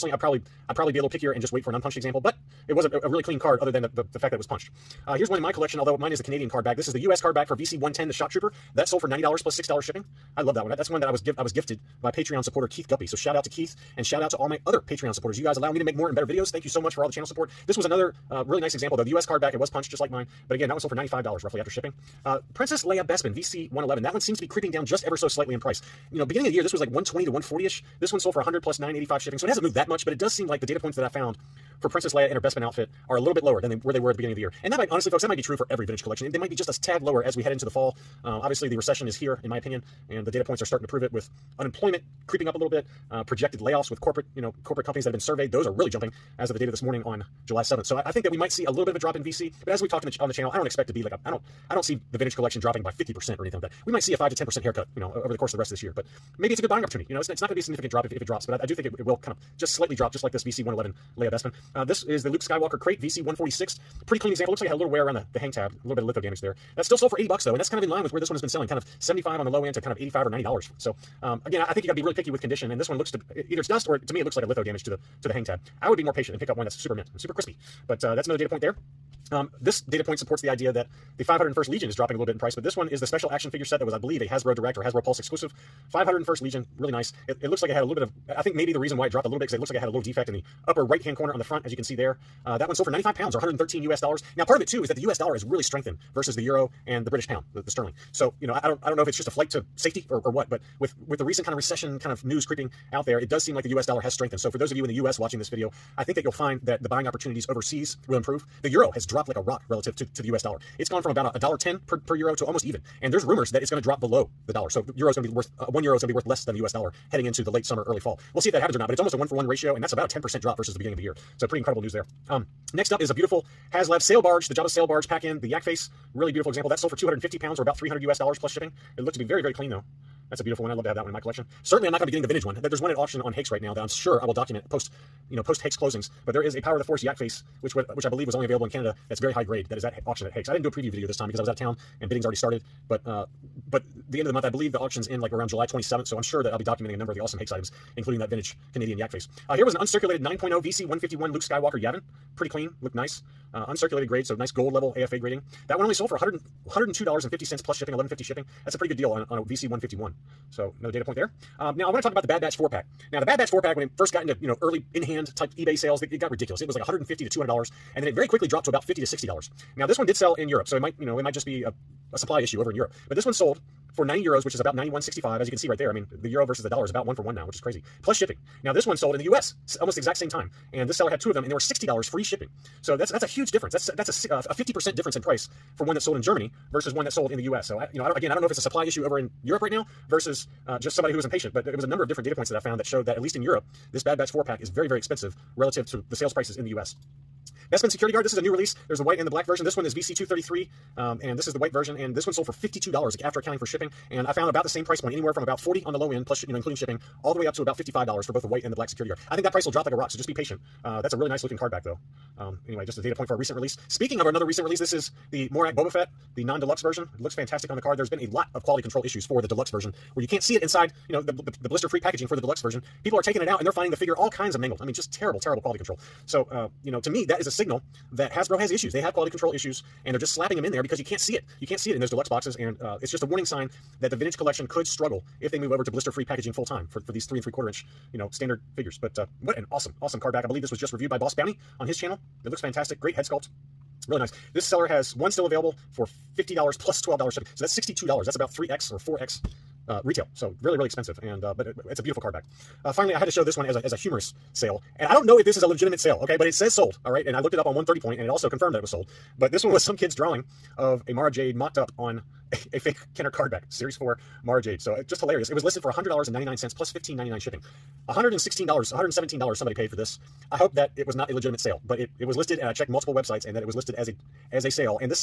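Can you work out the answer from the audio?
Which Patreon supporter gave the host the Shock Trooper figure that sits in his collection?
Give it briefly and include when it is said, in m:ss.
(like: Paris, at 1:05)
Keith Guppy, at 0:12.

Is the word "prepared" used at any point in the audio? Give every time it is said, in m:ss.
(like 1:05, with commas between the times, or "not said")
not said.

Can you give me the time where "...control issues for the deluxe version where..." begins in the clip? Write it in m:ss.
3:38.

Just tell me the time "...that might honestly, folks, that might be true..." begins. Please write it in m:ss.
0:34.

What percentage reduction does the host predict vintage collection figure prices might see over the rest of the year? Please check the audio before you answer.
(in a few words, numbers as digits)
5 to 10%.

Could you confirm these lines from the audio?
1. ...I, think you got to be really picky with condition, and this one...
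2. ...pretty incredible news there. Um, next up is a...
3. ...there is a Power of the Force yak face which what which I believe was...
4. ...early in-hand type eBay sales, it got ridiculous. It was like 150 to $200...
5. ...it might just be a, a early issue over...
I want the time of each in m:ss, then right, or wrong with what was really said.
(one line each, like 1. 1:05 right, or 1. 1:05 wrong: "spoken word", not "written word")
1. 1:11 right
2. 2:01 right
3. 2:16 right
4. 2:44 right
5. 2:51 wrong: "supply", not "early".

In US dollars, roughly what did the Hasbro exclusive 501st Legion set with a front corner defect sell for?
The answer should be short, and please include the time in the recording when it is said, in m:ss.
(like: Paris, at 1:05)
$113, at 1:33.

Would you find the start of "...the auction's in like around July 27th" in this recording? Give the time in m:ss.
2:24.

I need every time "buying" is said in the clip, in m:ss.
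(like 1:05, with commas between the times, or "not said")
0:56, 1:46.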